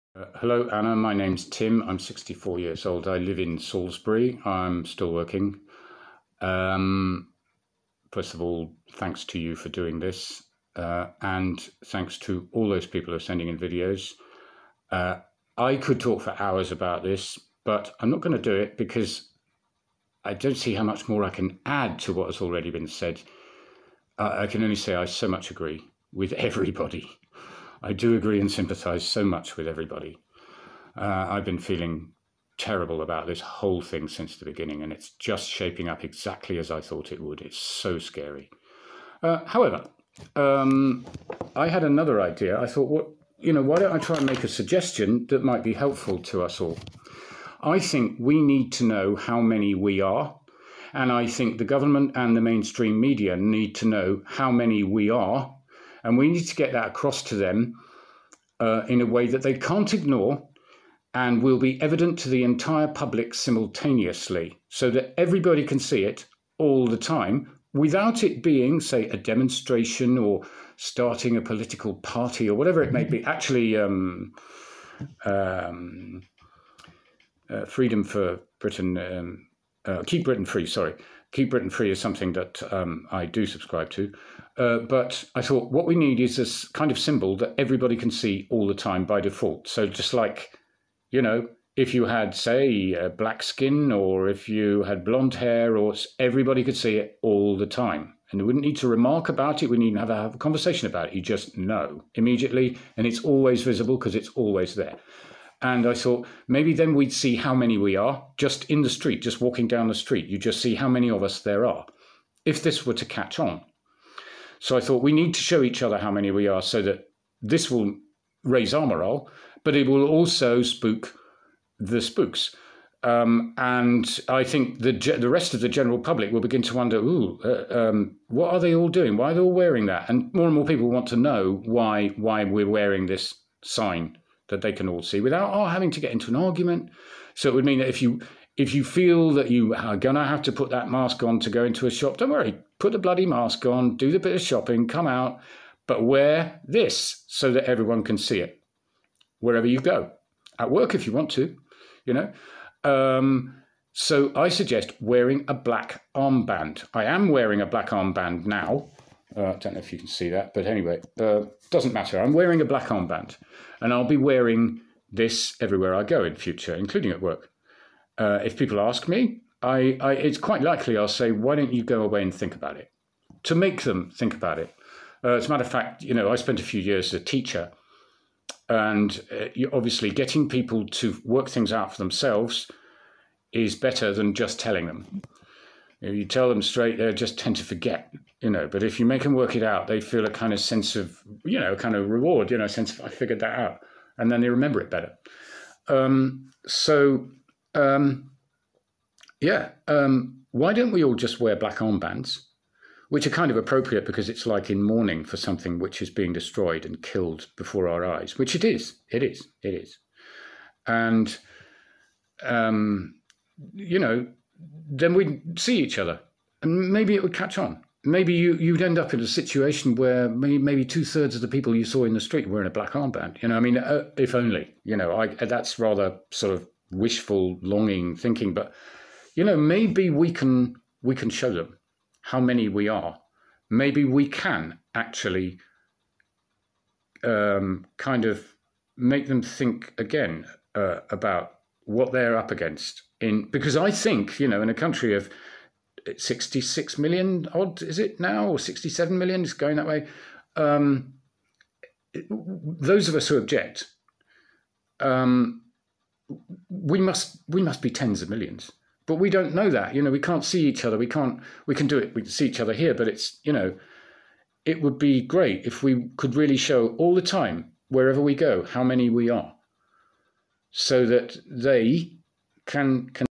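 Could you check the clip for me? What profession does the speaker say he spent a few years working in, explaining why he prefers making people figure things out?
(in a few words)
teacher.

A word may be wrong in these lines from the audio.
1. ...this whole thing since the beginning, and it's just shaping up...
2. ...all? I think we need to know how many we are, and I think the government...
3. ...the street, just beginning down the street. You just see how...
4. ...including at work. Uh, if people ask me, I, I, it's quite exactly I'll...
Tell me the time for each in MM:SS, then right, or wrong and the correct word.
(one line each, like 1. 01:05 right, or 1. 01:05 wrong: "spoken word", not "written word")
1. 00:33 right
2. 00:46 right
3. 01:48 wrong: "walking", not "beginning"
4. 02:46 wrong: "likely", not "exactly".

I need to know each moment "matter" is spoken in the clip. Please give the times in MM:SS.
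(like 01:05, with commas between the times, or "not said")
02:41, 02:55.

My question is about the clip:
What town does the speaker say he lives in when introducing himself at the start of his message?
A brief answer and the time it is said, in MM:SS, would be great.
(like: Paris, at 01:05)
Salisbury, at 00:03.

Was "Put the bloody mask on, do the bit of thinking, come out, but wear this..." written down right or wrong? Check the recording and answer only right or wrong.
wrong.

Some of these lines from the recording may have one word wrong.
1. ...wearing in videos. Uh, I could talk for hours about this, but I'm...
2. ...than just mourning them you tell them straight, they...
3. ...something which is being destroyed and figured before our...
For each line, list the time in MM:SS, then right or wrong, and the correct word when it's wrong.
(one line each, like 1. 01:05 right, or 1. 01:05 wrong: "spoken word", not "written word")
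1. 00:13 wrong: "sending", not "wearing"
2. 03:04 wrong: "telling", not "mourning"
3. 03:25 wrong: "killed", not "figured".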